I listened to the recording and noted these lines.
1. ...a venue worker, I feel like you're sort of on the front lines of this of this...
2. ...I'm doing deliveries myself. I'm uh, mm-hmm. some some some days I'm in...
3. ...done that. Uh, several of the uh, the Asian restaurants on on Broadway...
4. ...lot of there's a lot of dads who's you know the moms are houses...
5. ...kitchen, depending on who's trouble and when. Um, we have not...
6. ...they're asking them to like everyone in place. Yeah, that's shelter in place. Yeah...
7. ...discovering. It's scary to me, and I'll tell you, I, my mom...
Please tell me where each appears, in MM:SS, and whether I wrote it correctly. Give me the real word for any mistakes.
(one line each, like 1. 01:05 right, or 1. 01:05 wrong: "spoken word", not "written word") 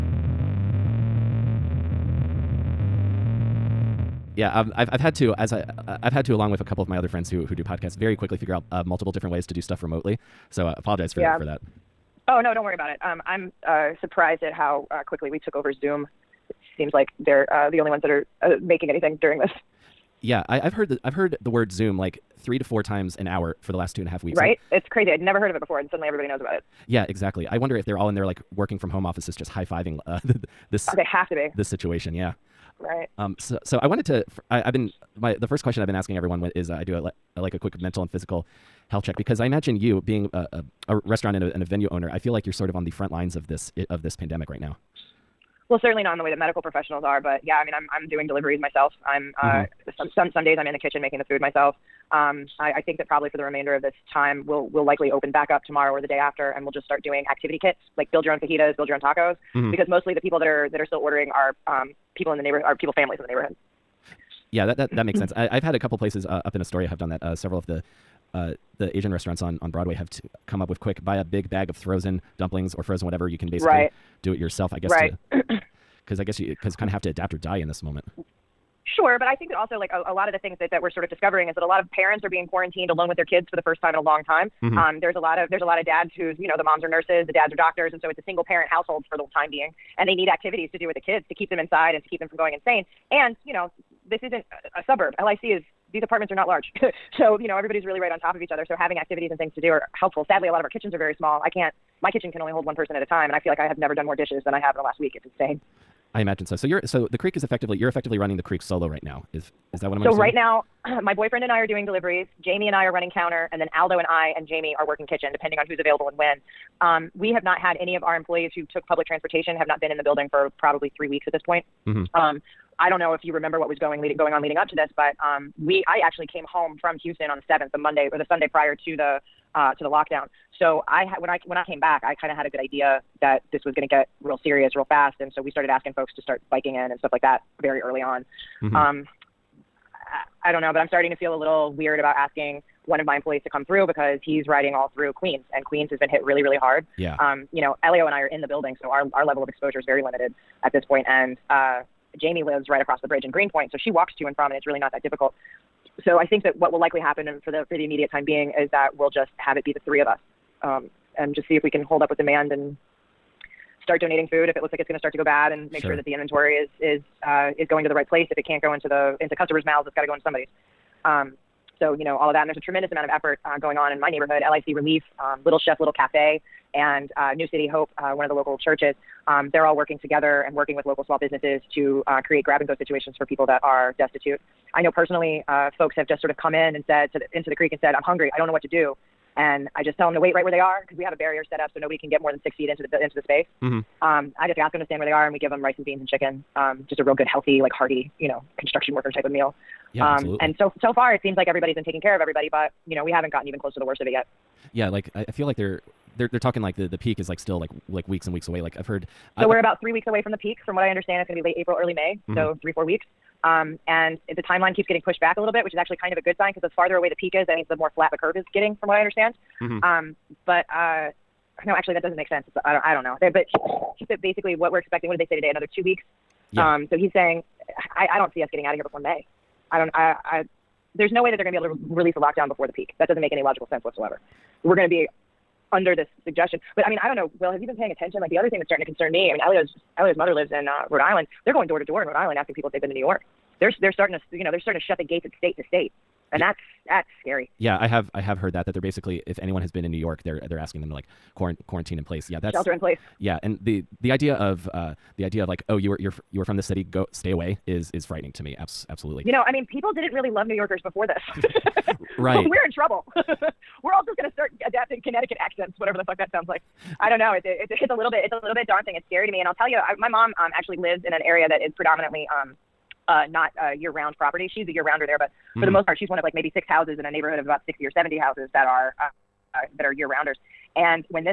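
1. 00:41 wrong: "owner", not "worker"
2. 00:47 right
3. 01:06 right
4. 01:25 wrong: "nurses", not "houses"
5. 01:55 wrong: "available", not "trouble"
6. 04:10 wrong: "quarantine", not "everyone"
7. 04:28 wrong: "daunting", not "discovering".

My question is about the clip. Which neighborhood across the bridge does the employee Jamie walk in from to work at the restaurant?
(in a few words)
Greenpoint.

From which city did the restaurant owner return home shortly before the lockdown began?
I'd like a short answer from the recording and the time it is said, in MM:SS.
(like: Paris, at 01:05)
Houston, at 02:07.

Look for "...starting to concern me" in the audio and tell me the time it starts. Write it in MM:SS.
03:58.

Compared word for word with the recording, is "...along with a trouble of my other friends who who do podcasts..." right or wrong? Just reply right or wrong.
wrong.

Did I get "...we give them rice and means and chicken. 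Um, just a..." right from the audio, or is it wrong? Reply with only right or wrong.
wrong.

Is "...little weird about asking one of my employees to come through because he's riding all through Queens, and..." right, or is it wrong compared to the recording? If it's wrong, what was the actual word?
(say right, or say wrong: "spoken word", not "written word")
right.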